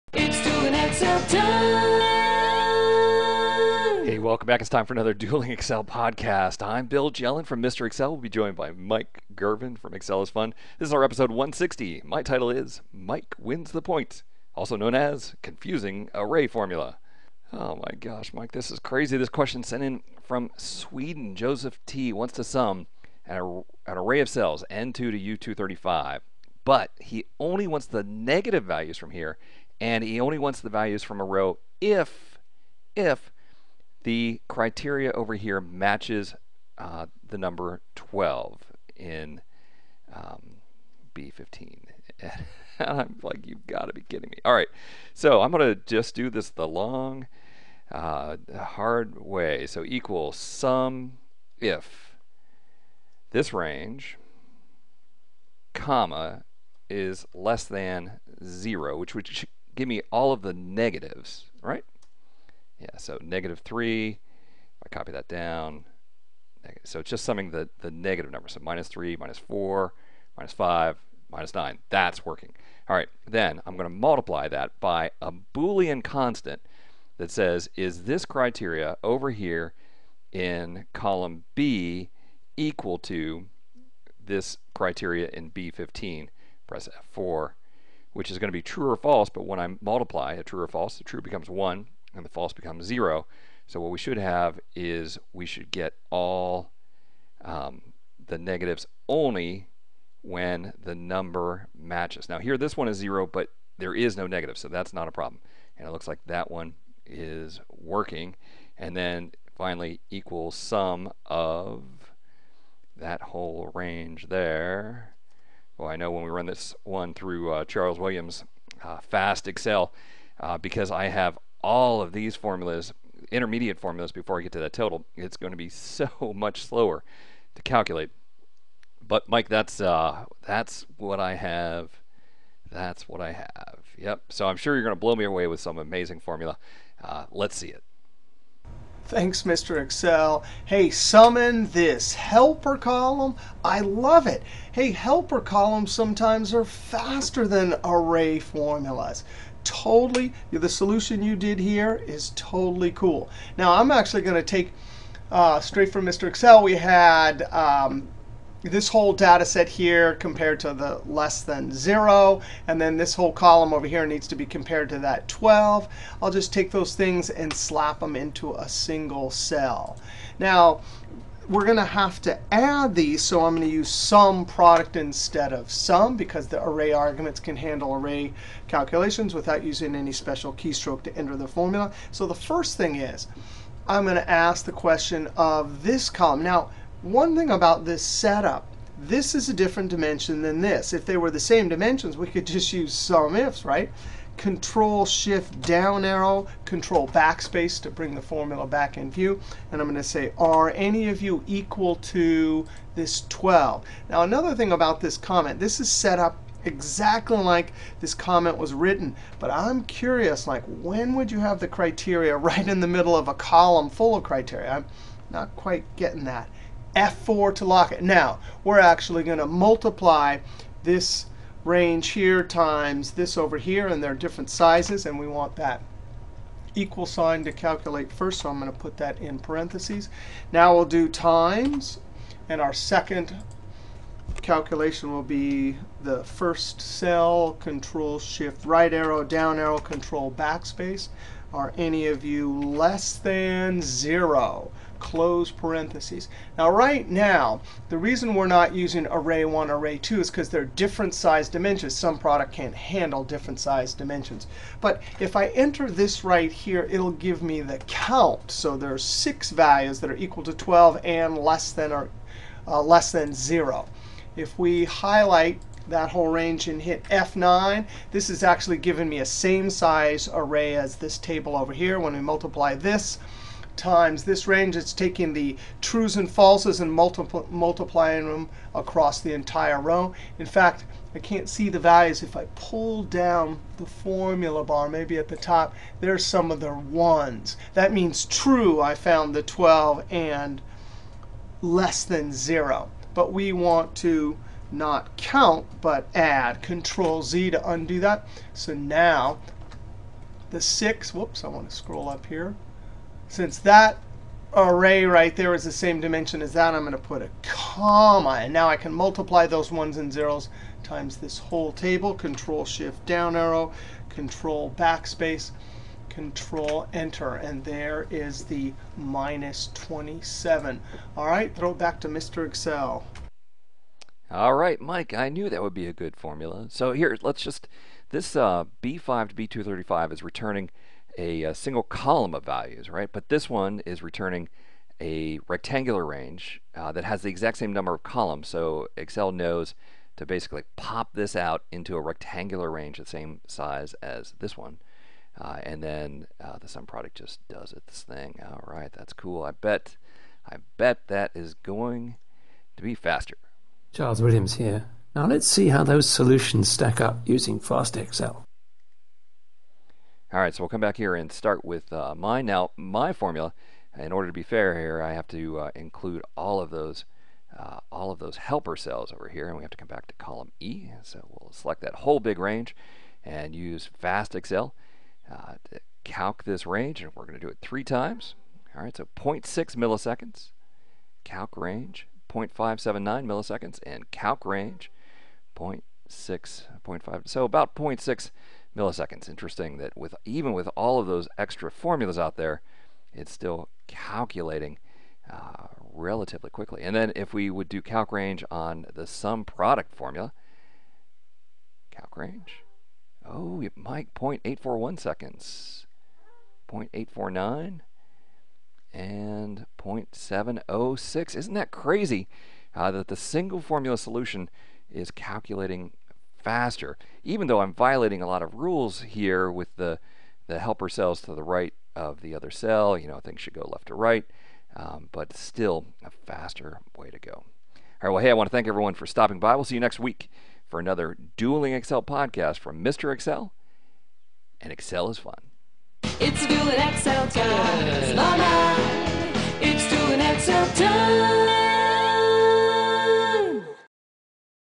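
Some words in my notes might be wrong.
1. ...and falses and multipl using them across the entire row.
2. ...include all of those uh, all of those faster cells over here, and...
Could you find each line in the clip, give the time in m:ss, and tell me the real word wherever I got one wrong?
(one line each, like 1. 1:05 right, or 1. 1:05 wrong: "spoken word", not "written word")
1. 4:36 wrong: "multiplying", not "using"
2. 6:05 wrong: "helper", not "faster".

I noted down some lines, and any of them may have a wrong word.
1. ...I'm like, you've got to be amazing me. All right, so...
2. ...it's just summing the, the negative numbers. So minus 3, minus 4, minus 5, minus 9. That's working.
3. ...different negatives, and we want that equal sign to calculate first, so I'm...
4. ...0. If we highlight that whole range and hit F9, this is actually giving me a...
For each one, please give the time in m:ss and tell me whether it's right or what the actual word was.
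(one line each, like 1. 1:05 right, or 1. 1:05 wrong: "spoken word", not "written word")
1. 0:42 wrong: "kidding", not "amazing"
2. 1:06 right
3. 3:44 wrong: "sizes", not "negatives"
4. 4:23 right.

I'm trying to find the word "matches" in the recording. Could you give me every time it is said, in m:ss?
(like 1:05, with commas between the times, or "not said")
0:35, 1:41.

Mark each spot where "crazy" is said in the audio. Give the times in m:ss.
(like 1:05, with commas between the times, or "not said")
0:18, 6:51.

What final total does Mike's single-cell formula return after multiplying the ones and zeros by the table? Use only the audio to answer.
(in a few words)
-27.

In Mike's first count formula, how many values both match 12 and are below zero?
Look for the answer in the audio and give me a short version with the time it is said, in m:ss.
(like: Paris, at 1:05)
6, at 4:18.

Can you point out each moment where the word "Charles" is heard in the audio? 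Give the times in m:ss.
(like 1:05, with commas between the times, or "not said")
1:57, 5:53.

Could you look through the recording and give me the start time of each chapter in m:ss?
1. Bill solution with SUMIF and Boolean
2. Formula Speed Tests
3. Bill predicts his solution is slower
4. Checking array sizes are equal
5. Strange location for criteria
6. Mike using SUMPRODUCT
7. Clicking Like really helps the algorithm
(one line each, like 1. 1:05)
1. 0:46
2. 5:52
3. 1:52
4. 4:06
5. 3:29
6. 2:33
7. 7:03.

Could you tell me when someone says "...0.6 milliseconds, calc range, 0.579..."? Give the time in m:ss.
6:19.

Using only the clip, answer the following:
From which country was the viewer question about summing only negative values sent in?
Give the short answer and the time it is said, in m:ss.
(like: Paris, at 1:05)
Sweden, at 0:20.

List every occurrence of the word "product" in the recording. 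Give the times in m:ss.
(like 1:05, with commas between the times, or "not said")
2:54, 4:12, 5:46, 6:39.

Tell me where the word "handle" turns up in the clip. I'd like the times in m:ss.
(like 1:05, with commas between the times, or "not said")
2:57, 4:12.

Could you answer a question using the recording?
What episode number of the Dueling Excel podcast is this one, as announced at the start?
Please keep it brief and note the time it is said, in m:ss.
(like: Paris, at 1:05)
160, at 0:11.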